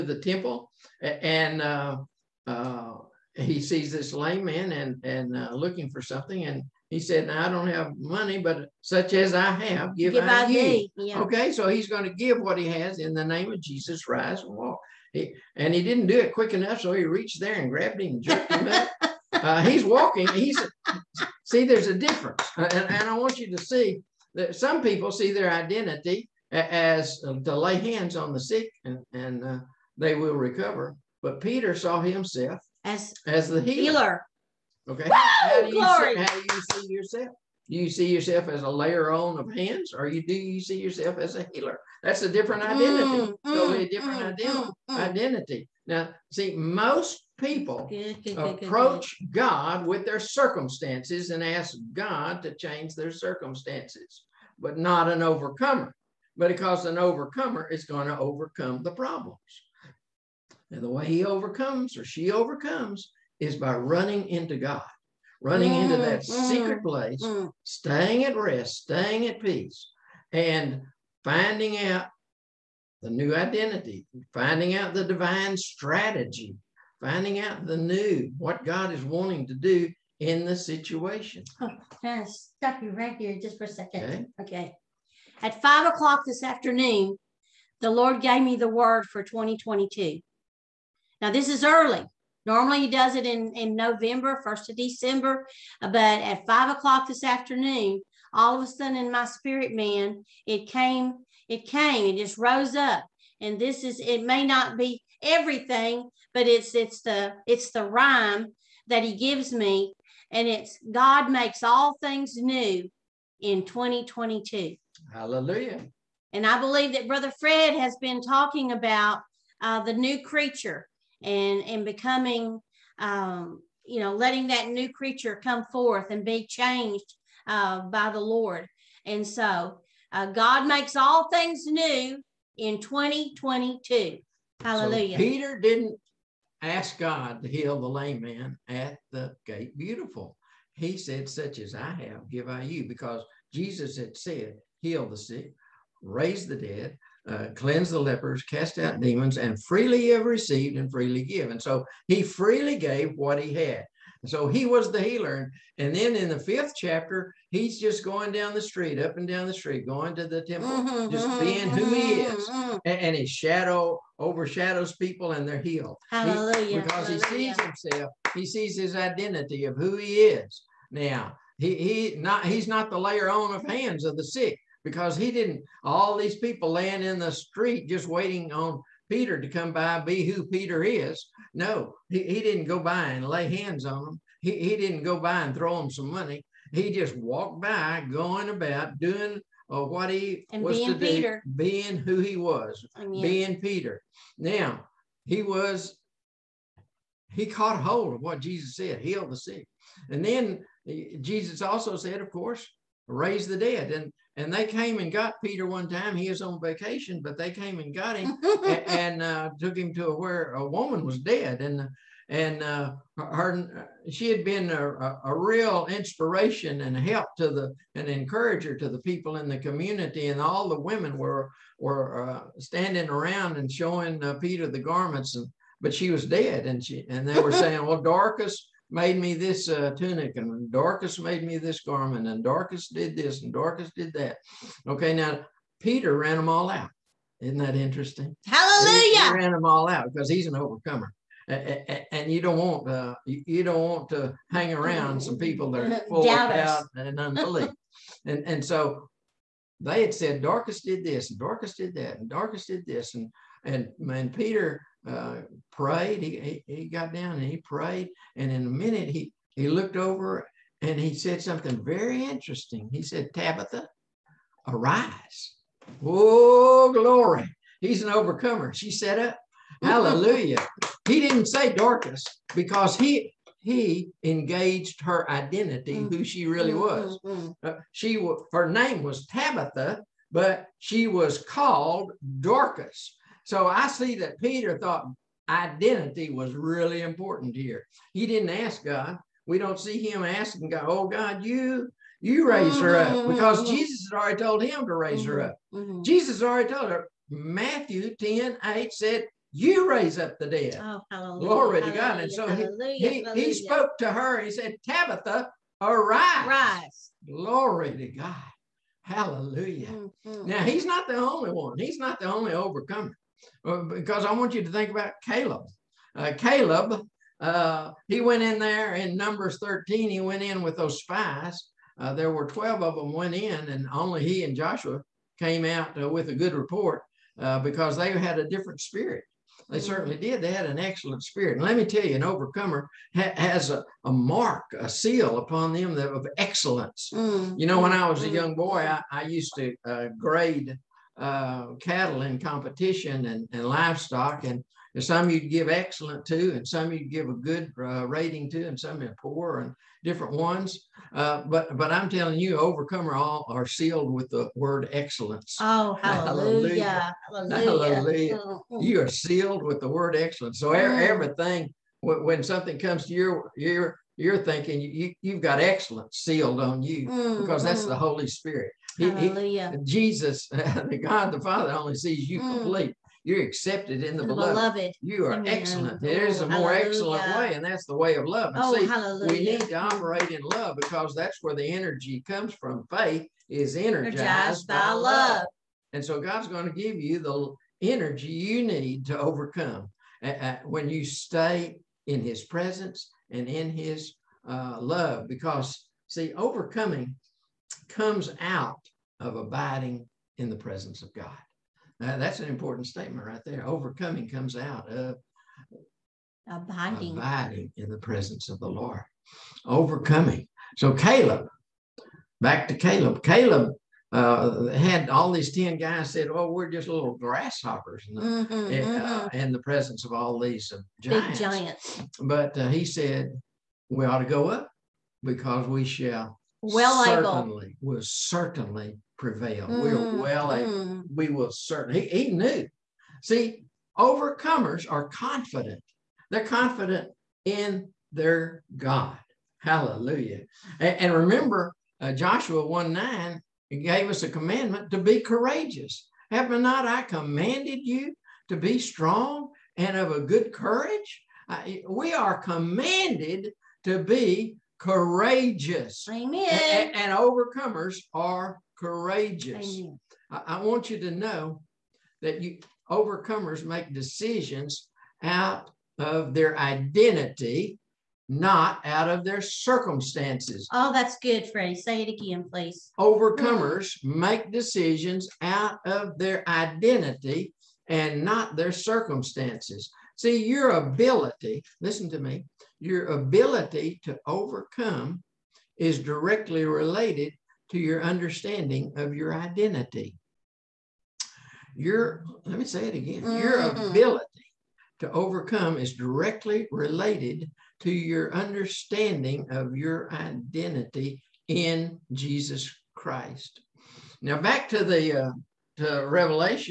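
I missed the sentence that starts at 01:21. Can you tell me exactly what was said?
Oh, I'm stop you right here just for a second.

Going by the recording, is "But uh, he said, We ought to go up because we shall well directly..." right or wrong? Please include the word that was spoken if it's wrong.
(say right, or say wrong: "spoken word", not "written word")
wrong: "certainly", not "directly".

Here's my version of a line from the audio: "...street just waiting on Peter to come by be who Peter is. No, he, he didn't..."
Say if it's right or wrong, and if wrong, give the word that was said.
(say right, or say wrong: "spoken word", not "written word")
right.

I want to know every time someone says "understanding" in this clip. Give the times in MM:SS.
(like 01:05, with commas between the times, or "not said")
08:08, 08:18.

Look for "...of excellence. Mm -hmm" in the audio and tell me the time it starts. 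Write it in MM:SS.
05:35.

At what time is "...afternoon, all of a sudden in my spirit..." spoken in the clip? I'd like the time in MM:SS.
01:37.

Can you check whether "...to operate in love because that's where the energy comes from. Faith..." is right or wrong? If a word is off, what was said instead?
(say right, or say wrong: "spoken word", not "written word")
right.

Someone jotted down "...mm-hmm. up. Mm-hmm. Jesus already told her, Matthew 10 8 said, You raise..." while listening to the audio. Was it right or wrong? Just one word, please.
right.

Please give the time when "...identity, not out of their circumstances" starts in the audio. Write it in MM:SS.
07:46.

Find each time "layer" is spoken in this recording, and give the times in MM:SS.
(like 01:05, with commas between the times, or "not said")
00:38, 02:52.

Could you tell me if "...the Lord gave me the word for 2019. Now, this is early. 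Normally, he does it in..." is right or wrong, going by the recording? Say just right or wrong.
wrong.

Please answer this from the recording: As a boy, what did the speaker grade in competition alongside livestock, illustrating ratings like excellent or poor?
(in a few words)
cattle.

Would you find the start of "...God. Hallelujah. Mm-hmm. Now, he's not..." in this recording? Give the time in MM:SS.
05:08.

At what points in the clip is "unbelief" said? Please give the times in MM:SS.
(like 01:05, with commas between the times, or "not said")
04:07.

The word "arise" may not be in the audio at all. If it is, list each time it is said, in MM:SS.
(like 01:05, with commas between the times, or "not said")
04:24, 05:05.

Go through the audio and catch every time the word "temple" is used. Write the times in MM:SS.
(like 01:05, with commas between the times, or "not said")
00:00, 02:40.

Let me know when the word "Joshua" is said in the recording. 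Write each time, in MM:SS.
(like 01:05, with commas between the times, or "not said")
05:24, 07:22.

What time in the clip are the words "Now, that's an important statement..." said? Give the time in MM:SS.
06:41.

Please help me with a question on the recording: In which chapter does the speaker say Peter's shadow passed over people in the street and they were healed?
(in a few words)
fifth chapter.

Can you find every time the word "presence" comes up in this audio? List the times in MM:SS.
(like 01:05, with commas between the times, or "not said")
06:32, 06:40, 06:47, 06:59.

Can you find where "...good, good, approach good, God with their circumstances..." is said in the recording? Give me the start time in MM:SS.
00:47.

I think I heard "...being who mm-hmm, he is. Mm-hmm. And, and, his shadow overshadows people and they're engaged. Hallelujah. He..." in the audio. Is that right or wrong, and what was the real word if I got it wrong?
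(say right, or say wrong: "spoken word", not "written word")
wrong: "healed", not "engaged".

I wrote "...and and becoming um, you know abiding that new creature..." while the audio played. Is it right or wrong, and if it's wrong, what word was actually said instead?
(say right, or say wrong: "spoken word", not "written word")
wrong: "letting", not "abiding".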